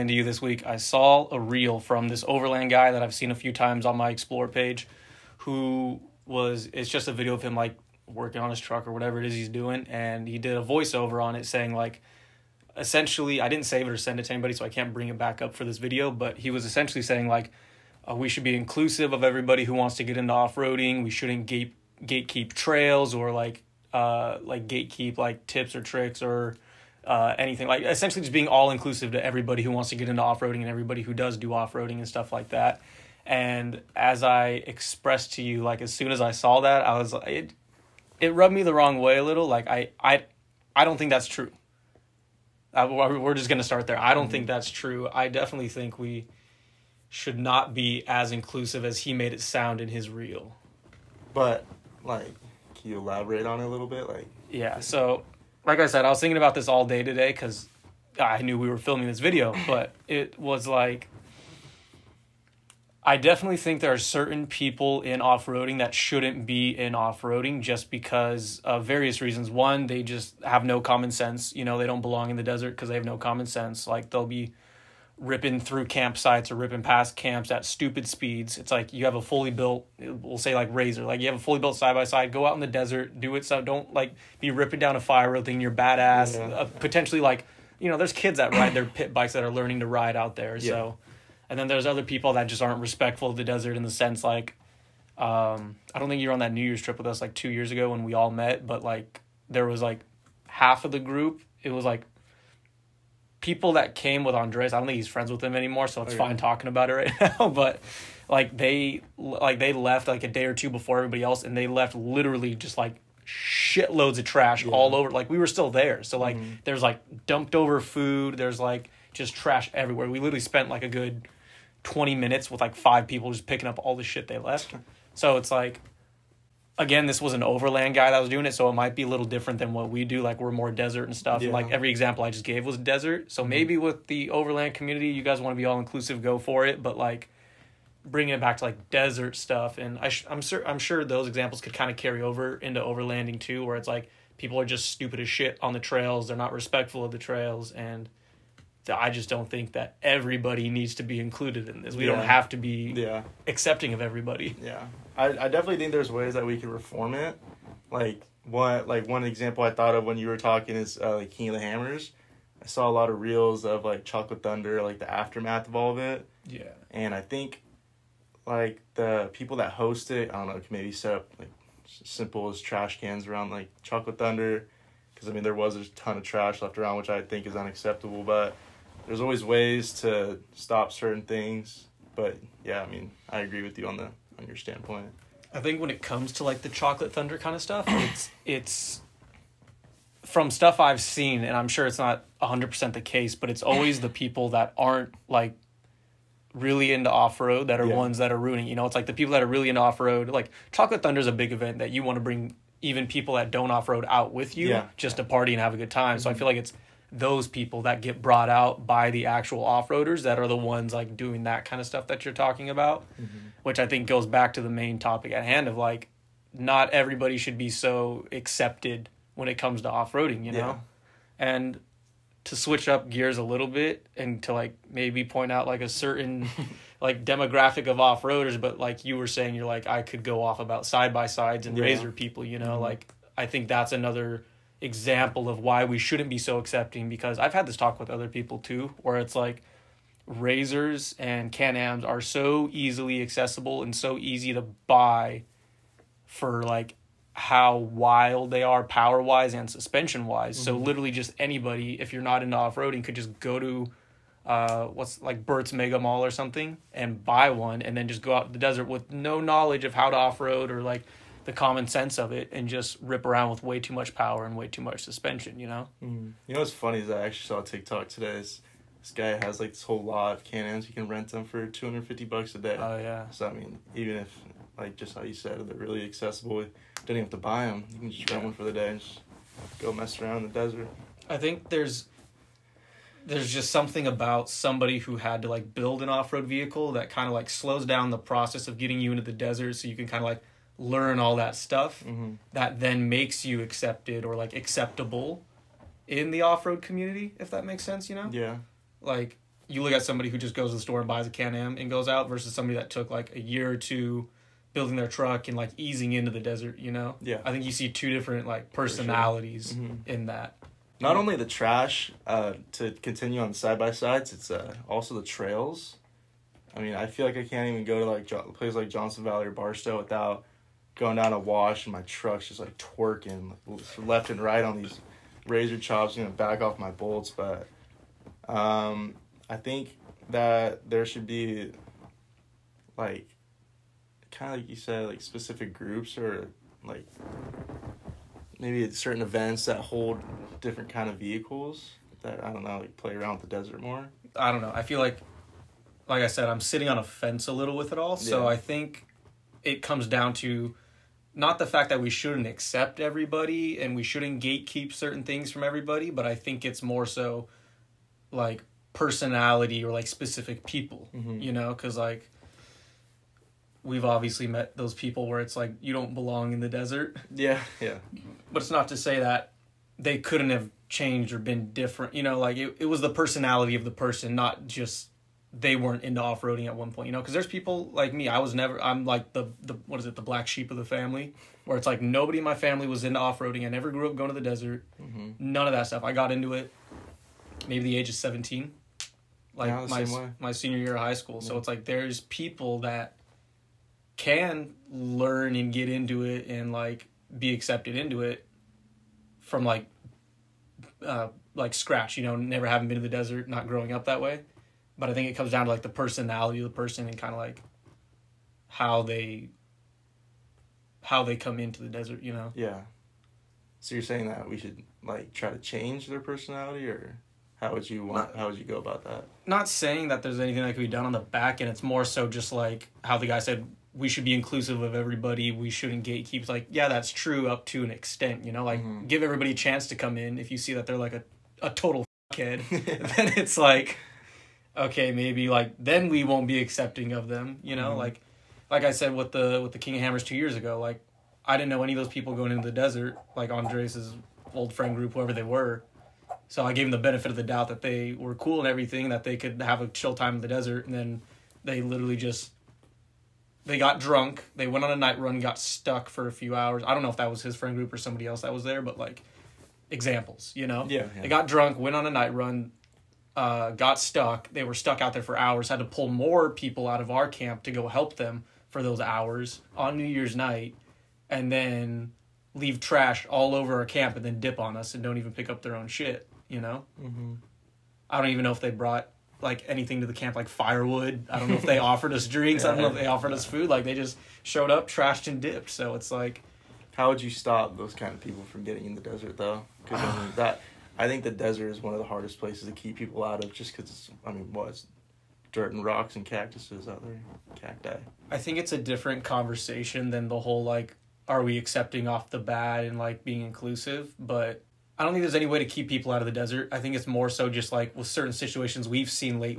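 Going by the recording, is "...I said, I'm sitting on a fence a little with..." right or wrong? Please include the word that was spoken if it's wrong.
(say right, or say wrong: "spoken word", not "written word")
right.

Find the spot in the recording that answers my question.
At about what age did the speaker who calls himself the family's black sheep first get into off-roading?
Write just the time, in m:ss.
6:28.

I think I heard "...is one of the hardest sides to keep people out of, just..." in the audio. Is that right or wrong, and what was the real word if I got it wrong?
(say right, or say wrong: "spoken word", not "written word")
wrong: "places", not "sides".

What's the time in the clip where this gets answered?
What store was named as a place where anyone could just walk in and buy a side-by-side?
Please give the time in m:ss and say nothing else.
4:15.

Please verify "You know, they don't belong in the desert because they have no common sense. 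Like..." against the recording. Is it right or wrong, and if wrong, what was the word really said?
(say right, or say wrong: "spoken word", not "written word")
right.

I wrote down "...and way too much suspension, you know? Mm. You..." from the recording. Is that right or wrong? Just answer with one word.
right.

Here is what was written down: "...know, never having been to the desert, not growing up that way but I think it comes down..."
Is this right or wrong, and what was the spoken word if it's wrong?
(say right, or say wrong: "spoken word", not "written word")
right.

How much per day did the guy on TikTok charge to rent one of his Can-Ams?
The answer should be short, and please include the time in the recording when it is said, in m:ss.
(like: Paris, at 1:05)
$250, at 4:31.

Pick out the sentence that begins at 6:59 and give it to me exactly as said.
Not saying that there's anything that could be done on the back end.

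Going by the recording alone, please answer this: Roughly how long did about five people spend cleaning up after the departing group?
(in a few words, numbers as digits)
20 minutes.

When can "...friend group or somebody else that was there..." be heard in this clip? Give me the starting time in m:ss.
7:37.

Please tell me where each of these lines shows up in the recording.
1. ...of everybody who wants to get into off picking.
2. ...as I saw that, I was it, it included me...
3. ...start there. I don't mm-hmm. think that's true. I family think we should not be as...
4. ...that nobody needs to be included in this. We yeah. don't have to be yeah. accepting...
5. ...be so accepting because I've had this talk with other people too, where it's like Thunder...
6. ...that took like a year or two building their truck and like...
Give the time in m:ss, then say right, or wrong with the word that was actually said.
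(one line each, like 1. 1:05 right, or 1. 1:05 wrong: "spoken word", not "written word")
1. 0:19 wrong: "roading", not "picking"
2. 0:36 wrong: "rubbed", not "included"
3. 0:43 wrong: "definitely", not "family"
4. 2:29 wrong: "everybody", not "nobody"
5. 3:56 wrong: "RZRs", not "Thunder"
6. 5:02 right.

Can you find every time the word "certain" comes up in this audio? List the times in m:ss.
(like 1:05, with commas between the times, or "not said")
1:03, 3:00, 3:45, 5:38, 5:54, 8:28.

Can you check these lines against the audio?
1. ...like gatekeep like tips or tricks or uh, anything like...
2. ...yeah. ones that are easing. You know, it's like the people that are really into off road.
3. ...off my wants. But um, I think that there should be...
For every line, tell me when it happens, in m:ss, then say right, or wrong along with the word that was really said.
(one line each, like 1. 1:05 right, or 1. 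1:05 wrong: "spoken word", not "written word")
1. 0:24 right
2. 3:17 wrong: "ruining", not "easing"
3. 5:26 wrong: "bolts", not "wants".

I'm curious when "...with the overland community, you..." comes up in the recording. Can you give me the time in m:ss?
2:13.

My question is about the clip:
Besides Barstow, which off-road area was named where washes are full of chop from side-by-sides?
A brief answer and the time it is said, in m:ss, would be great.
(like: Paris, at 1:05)
Johnson Valley, at 5:18.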